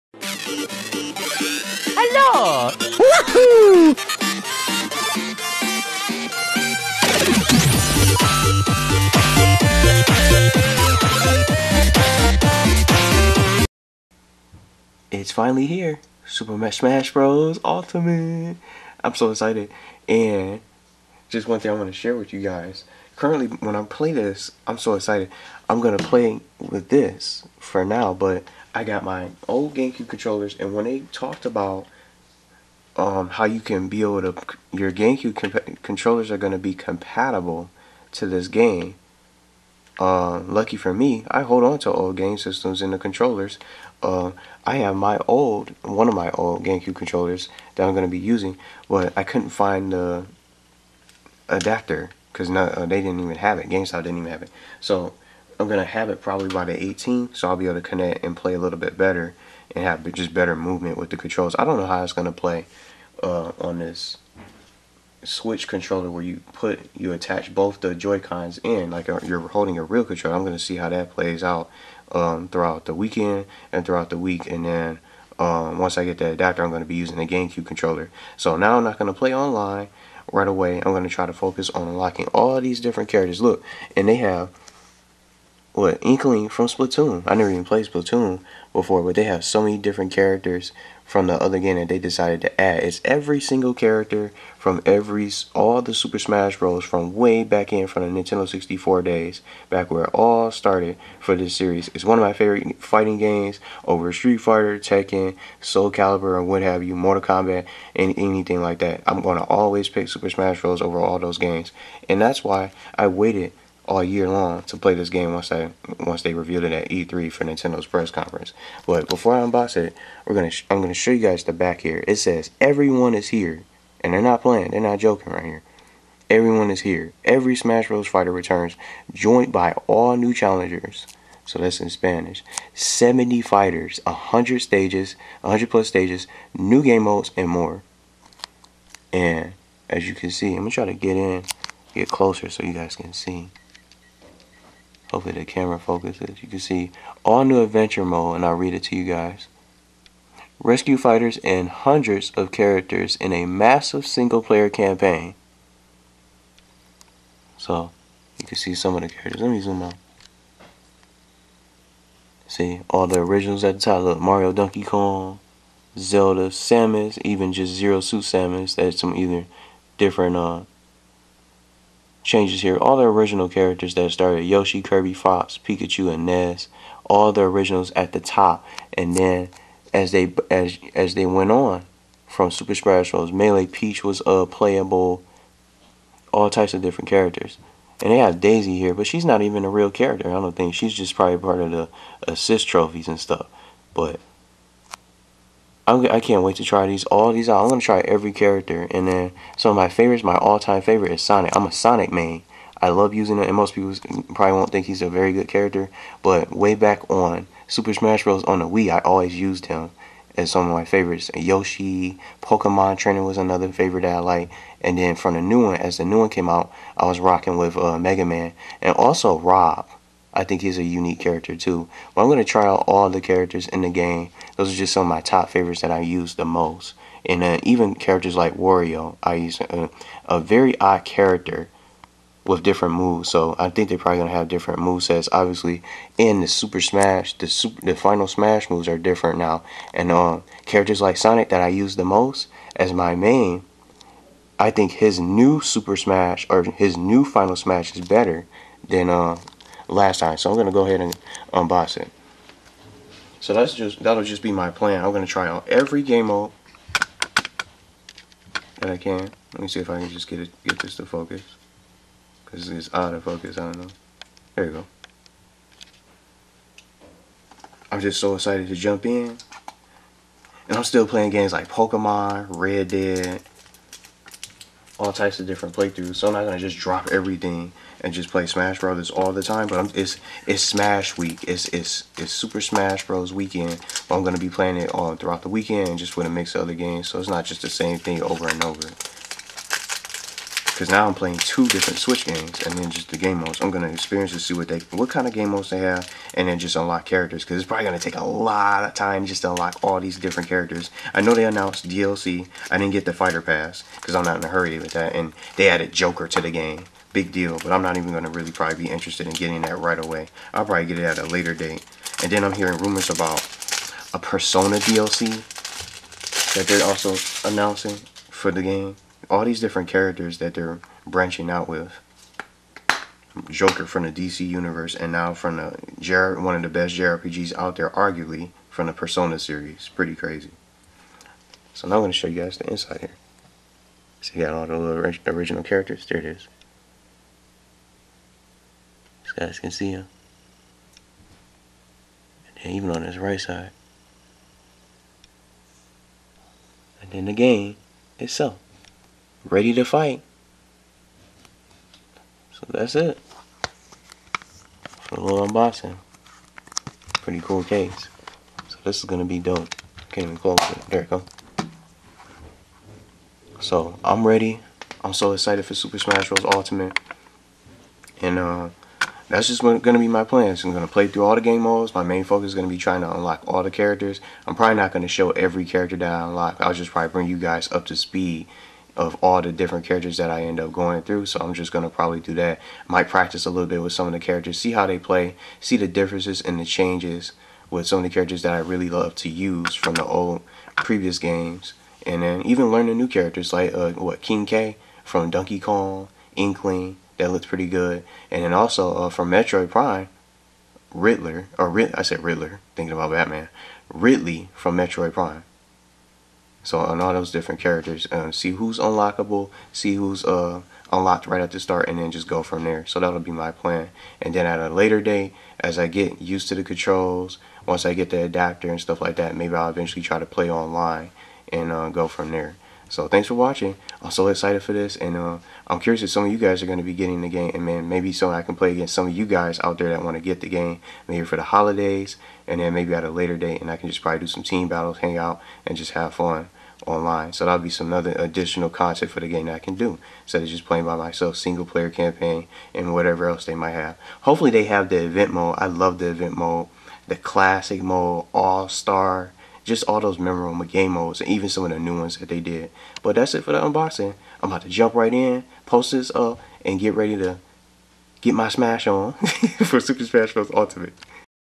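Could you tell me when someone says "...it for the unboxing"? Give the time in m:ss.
7:33.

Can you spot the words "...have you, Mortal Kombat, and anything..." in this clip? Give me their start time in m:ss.
1:46.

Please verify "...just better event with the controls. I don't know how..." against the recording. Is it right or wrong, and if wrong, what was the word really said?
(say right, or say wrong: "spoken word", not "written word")
wrong: "movement", not "event".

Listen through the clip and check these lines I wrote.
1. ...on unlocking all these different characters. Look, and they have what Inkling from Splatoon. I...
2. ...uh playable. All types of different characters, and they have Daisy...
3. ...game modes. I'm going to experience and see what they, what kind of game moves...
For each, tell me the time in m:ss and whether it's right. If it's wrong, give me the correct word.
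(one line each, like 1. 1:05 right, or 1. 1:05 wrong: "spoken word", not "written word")
1. 1:21 right
2. 3:04 right
3. 4:53 wrong: "modes", not "moves".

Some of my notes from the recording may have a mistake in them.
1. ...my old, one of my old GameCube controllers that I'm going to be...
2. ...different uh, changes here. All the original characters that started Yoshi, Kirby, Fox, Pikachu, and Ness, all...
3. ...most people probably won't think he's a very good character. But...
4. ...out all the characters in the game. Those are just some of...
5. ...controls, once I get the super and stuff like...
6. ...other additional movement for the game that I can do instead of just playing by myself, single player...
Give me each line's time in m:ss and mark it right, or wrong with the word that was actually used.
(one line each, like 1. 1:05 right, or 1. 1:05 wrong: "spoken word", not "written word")
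1. 0:44 right
2. 2:49 right
3. 3:23 right
4. 3:42 right
5. 6:56 wrong: "adapter", not "super"
6. 7:17 wrong: "content", not "movement".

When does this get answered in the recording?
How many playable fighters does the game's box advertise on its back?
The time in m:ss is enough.
2:12.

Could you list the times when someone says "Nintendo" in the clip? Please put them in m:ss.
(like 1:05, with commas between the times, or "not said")
1:38, 1:57.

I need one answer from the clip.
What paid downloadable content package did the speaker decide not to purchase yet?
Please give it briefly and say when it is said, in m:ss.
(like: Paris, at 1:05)
Fighter Pass, at 5:03.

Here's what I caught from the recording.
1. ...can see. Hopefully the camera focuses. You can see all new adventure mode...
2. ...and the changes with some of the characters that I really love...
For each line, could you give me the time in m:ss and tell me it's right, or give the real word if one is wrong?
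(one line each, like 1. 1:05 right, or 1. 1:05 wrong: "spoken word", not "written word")
1. 2:22 right
2. 6:26 right.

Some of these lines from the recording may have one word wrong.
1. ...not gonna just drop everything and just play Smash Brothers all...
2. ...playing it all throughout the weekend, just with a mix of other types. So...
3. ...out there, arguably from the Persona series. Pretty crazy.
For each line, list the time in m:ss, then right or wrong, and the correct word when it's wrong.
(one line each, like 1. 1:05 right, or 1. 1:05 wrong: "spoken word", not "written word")
1. 4:36 right
2. 4:44 wrong: "games", not "types"
3. 5:27 right.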